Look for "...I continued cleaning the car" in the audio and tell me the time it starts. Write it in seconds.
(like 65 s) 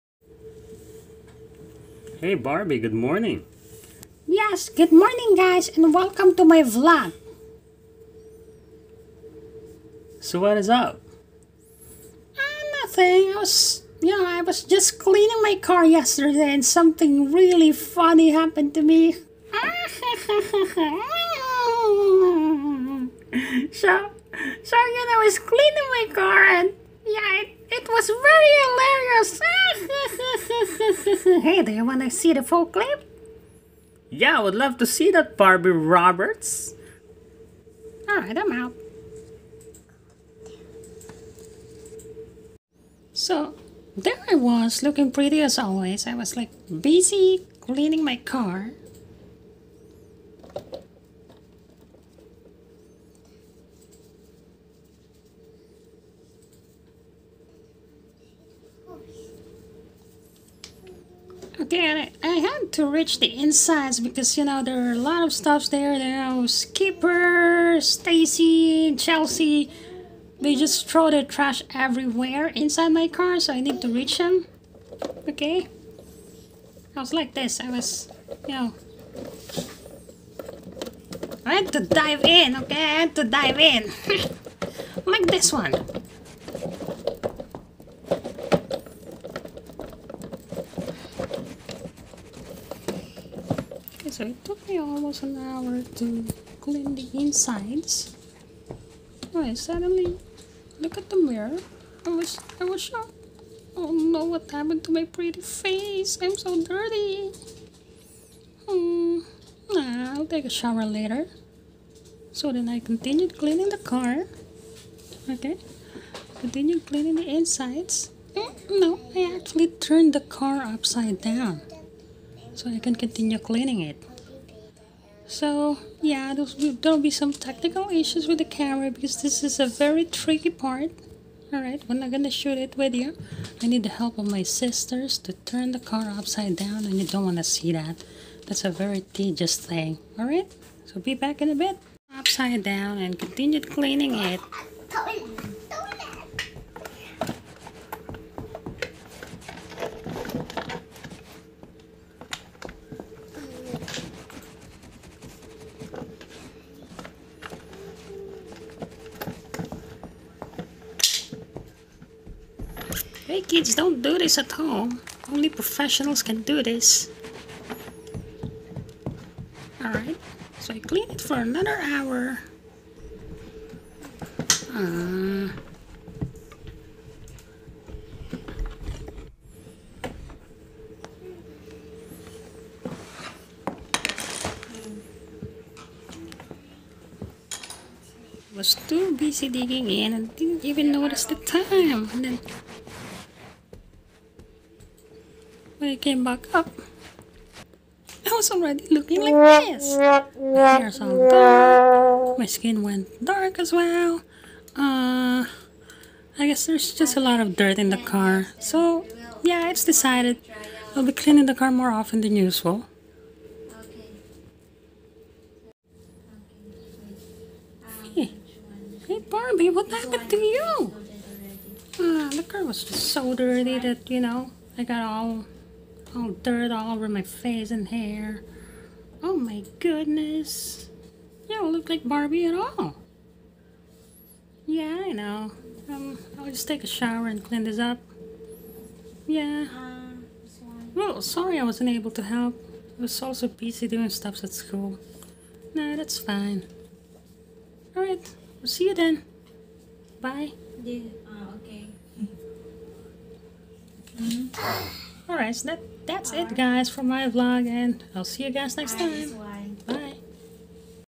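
112 s.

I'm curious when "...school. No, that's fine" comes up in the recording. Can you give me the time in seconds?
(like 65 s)
244 s.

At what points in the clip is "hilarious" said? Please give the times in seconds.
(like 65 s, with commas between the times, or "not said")
29 s.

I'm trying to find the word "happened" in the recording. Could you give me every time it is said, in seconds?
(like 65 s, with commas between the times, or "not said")
18 s, 104 s, 219 s.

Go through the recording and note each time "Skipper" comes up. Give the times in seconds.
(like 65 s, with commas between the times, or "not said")
66 s.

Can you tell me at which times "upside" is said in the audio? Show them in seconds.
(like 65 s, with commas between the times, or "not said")
120 s, 136 s, 142 s.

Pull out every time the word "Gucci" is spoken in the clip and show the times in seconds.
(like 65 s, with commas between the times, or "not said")
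not said.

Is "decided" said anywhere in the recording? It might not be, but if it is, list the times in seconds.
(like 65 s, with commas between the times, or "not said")
209 s.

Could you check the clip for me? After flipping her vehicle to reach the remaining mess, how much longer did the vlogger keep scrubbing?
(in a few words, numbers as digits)
another hour.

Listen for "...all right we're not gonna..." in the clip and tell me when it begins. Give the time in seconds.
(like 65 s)
131 s.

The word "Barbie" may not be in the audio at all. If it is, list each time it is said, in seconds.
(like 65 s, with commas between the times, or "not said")
2 s, 35 s, 219 s, 232 s.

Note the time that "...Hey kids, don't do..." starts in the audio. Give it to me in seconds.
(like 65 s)
163 s.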